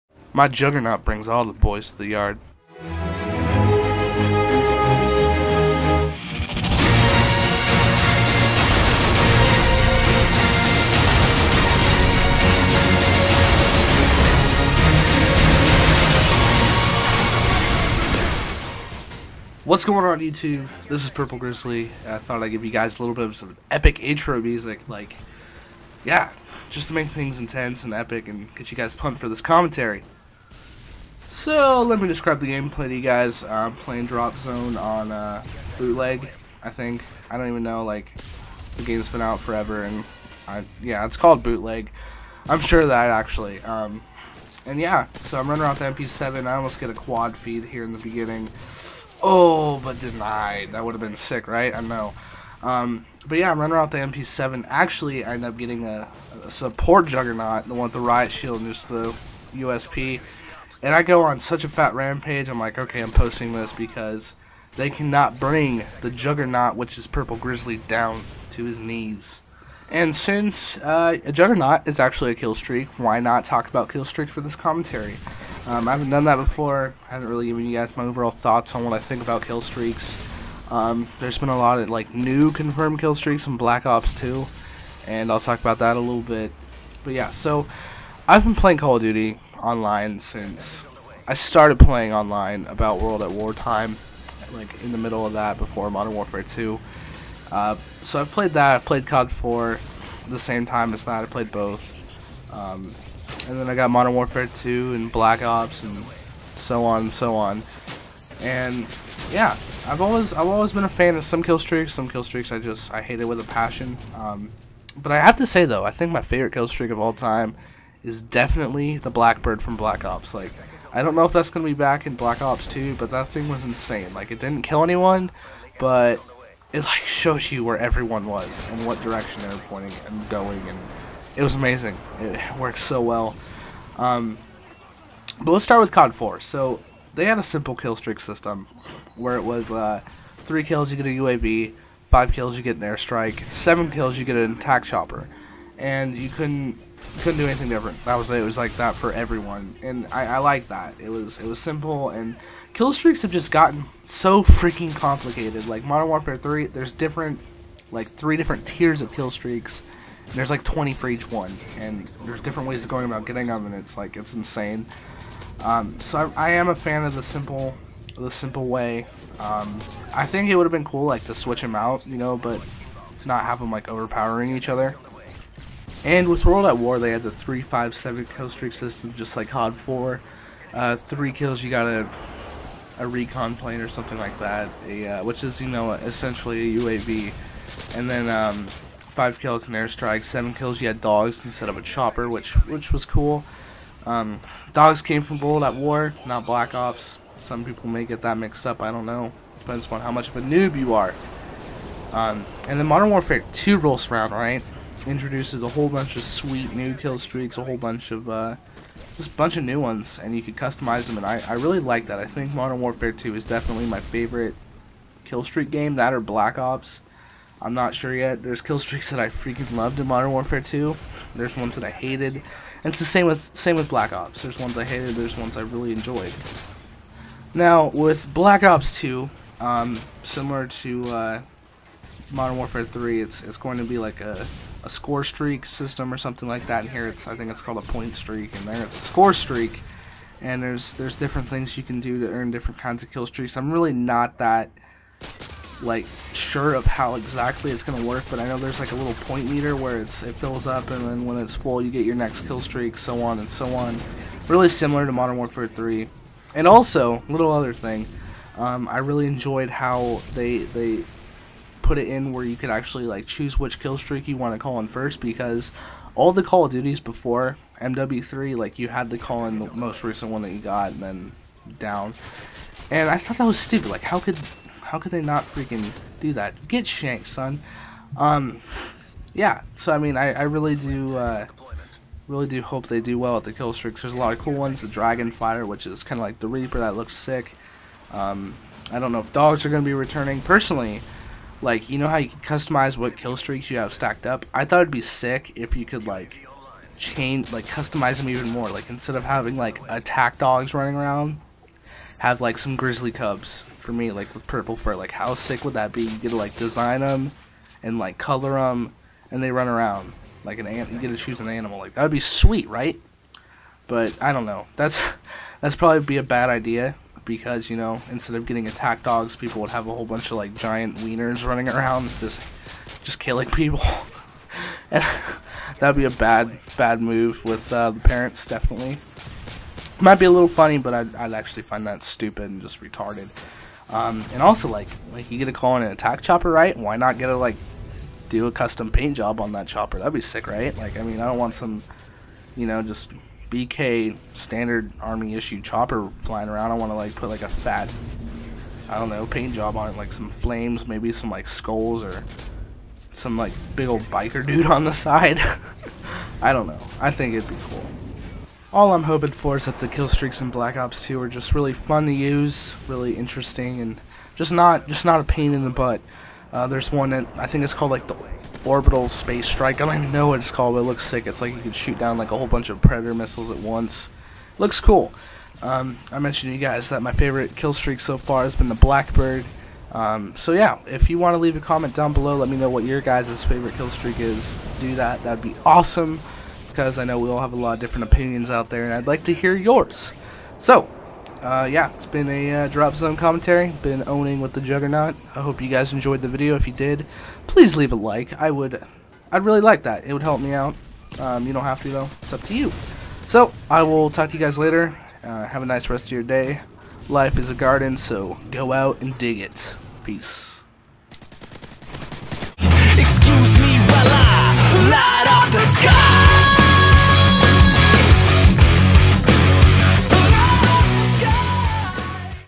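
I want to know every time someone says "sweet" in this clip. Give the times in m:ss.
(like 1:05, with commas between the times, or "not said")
3:26, 5:12.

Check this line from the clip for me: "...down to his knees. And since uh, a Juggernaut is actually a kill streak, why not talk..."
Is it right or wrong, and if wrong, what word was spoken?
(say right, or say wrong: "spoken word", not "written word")
right.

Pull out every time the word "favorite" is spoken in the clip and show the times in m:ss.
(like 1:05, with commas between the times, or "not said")
1:56, 3:33, 6:17, 6:23.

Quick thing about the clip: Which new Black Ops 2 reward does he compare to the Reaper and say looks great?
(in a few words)
Dragonfire.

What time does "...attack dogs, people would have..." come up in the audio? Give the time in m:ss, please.
5:18.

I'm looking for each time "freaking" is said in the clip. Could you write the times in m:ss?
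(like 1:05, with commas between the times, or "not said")
2:34, 3:39, 4:35.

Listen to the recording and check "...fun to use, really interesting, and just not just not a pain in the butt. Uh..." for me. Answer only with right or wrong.
right.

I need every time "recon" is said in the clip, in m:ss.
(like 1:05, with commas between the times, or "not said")
3:03.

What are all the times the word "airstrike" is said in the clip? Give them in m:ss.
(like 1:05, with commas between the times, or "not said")
2:22, 3:09.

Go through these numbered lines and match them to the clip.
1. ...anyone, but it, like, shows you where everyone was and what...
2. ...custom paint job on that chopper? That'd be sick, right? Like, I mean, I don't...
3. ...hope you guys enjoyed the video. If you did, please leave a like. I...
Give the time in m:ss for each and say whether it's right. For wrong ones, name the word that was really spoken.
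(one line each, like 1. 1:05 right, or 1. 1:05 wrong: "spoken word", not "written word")
1. 2:04 right
2. 5:38 right
3. 6:35 right.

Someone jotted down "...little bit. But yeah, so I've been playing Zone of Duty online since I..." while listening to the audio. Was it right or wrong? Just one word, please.
wrong.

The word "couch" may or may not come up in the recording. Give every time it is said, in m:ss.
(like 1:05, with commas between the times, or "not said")
not said.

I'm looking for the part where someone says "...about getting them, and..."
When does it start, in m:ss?
2:43.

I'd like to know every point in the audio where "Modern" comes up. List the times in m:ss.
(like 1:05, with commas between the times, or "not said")
1:35, 1:43, 2:35, 3:22, 3:32, 3:40, 3:52, 4:15.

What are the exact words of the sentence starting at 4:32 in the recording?
And I thought that was stupid.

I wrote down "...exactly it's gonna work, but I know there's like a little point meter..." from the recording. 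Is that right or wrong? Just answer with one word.
right.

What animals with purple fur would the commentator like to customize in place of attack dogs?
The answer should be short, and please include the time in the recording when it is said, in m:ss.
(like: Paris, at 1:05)
grizzly cubs, at 5:02.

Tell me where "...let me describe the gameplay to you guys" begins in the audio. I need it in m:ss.
0:31.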